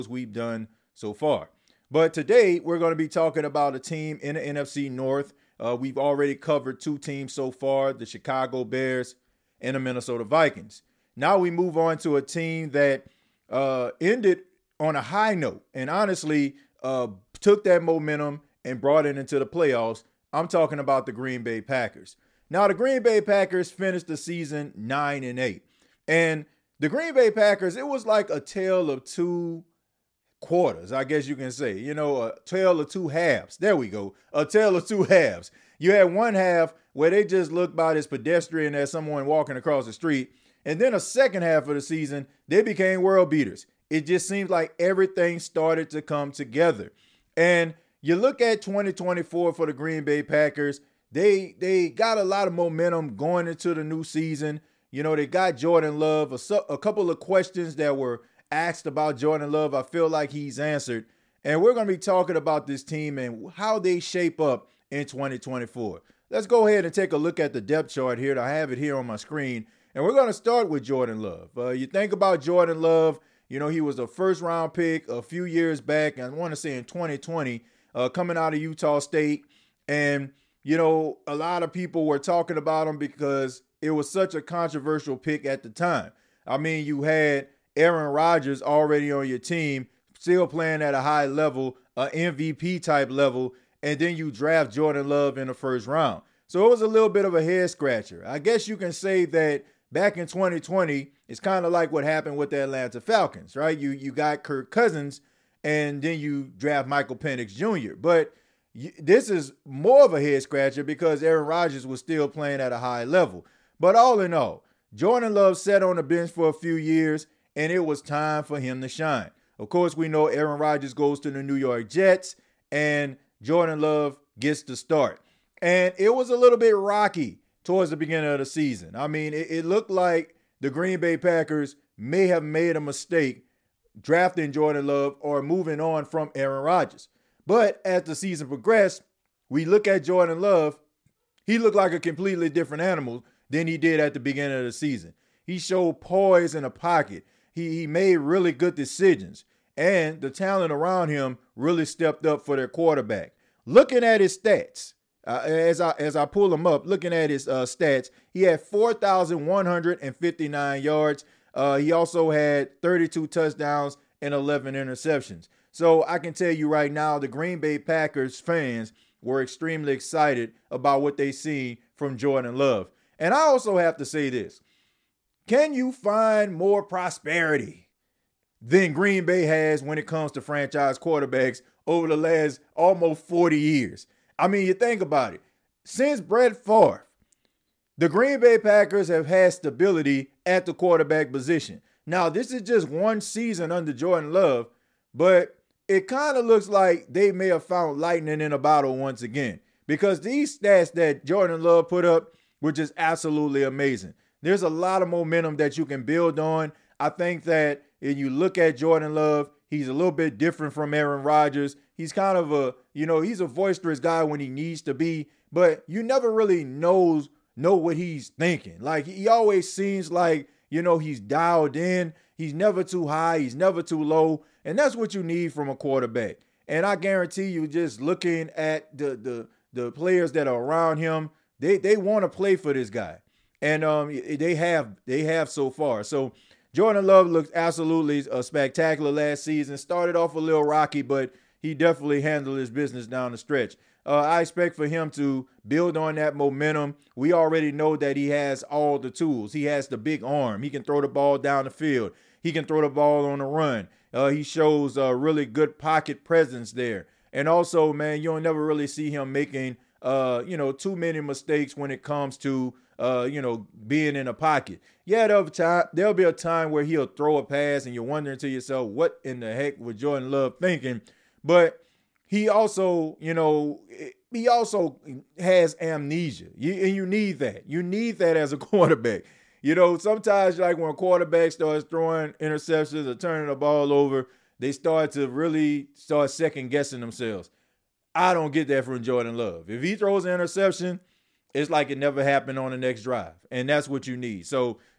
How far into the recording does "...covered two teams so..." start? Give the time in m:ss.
0:06.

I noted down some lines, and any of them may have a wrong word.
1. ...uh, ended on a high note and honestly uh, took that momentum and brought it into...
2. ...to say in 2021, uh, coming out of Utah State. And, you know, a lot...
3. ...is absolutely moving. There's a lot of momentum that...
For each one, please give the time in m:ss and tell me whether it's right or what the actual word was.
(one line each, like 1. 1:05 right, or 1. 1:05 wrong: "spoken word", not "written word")
1. 0:13 right
2. 1:16 wrong: "2020", not "2021"
3. 3:22 wrong: "amazing", not "moving".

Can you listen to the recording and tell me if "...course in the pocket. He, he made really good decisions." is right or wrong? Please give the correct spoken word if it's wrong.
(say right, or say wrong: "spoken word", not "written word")
wrong: "poise", not "course".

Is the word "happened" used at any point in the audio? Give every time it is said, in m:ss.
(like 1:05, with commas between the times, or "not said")
1:42, 4:52.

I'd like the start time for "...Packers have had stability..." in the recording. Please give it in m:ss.
3:08.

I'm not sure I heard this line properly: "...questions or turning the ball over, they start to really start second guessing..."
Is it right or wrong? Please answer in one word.
wrong.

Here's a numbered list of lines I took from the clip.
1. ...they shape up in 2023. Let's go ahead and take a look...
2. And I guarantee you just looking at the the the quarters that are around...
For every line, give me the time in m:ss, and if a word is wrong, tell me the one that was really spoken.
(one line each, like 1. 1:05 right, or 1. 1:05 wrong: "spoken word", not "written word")
1. 1:03 wrong: "2024", not "2023"
2. 3:46 wrong: "players", not "quarters".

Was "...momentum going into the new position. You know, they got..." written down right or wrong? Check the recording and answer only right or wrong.
wrong.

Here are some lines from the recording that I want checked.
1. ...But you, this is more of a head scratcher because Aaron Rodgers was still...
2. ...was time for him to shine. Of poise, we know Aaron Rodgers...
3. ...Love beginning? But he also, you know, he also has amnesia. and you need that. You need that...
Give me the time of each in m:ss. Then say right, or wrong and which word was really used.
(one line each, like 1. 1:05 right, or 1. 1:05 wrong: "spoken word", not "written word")
1. 1:47 right
2. 1:57 wrong: "course", not "poise"
3. 4:30 wrong: "thinking", not "beginning".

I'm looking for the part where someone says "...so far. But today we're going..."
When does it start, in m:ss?
0:00.